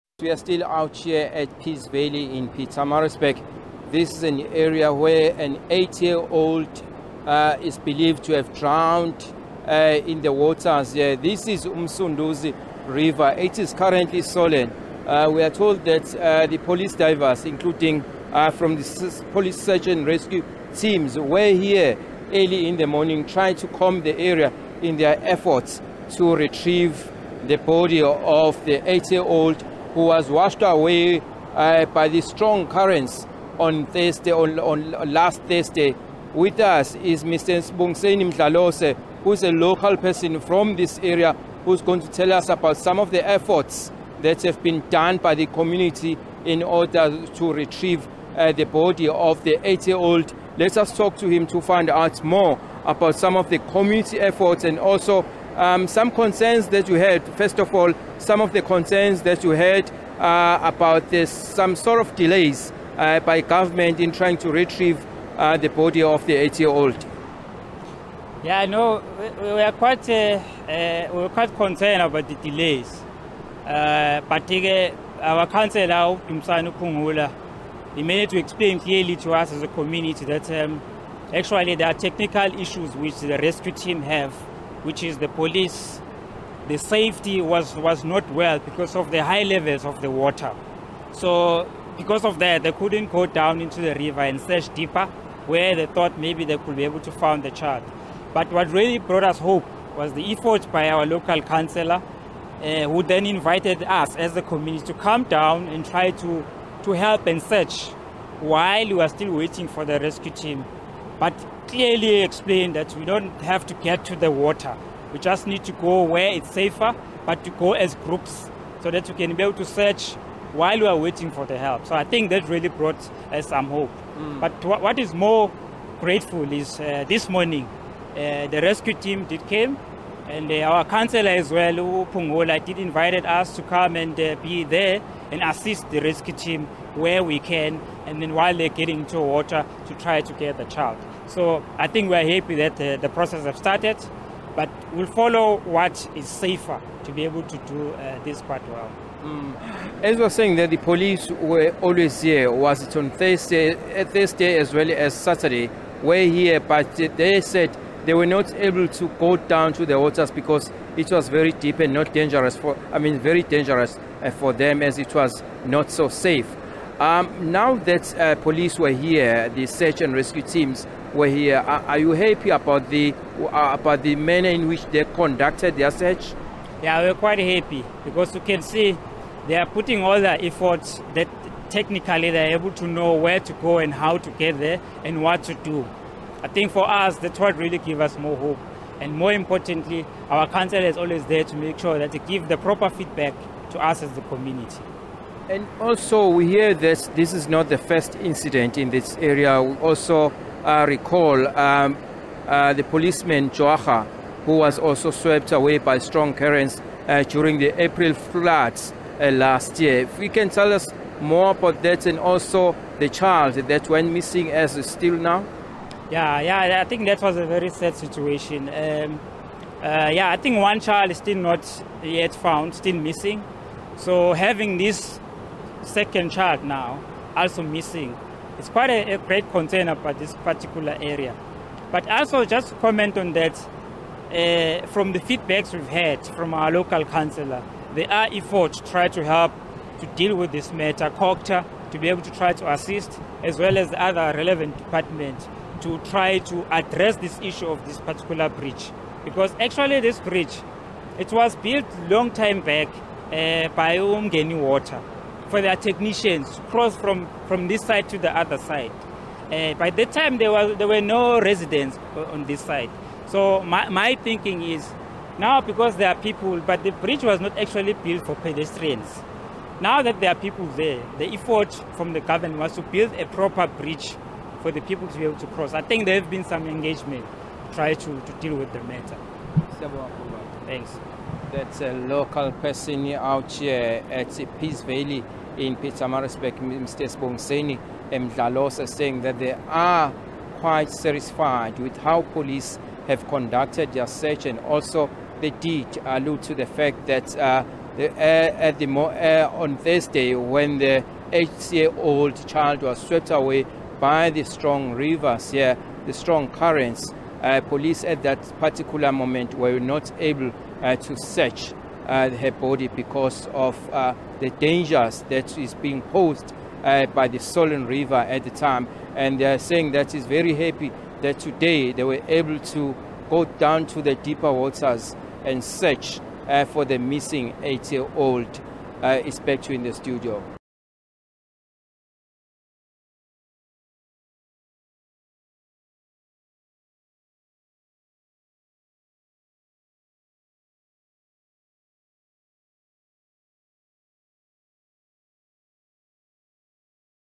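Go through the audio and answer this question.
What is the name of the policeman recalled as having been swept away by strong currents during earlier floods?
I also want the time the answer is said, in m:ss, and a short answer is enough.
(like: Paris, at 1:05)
Joacha, at 3:23.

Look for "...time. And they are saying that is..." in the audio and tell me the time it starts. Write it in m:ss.
5:18.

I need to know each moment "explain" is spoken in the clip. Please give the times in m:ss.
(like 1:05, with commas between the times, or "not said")
1:18, 1:52.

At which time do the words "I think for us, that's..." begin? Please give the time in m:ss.
3:06.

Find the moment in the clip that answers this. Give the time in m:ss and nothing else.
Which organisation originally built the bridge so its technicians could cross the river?
4:13.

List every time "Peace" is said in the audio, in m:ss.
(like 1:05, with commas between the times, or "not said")
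0:01, 4:44.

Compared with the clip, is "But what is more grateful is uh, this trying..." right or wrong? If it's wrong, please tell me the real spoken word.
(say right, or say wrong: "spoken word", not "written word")
wrong: "morning", not "trying".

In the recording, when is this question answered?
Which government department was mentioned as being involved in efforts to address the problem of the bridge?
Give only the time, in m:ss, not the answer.
4:01.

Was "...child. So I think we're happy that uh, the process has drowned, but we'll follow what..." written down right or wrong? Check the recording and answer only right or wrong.
wrong.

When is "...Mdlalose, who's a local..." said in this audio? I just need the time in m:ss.
0:38.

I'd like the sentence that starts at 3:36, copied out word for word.
Yeah, yeah, I think that was a very sad situation.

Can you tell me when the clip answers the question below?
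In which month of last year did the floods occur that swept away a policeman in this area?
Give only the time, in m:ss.
3:27.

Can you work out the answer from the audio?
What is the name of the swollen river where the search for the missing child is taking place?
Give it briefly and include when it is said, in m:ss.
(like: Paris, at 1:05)
Umsunduzi River, at 0:11.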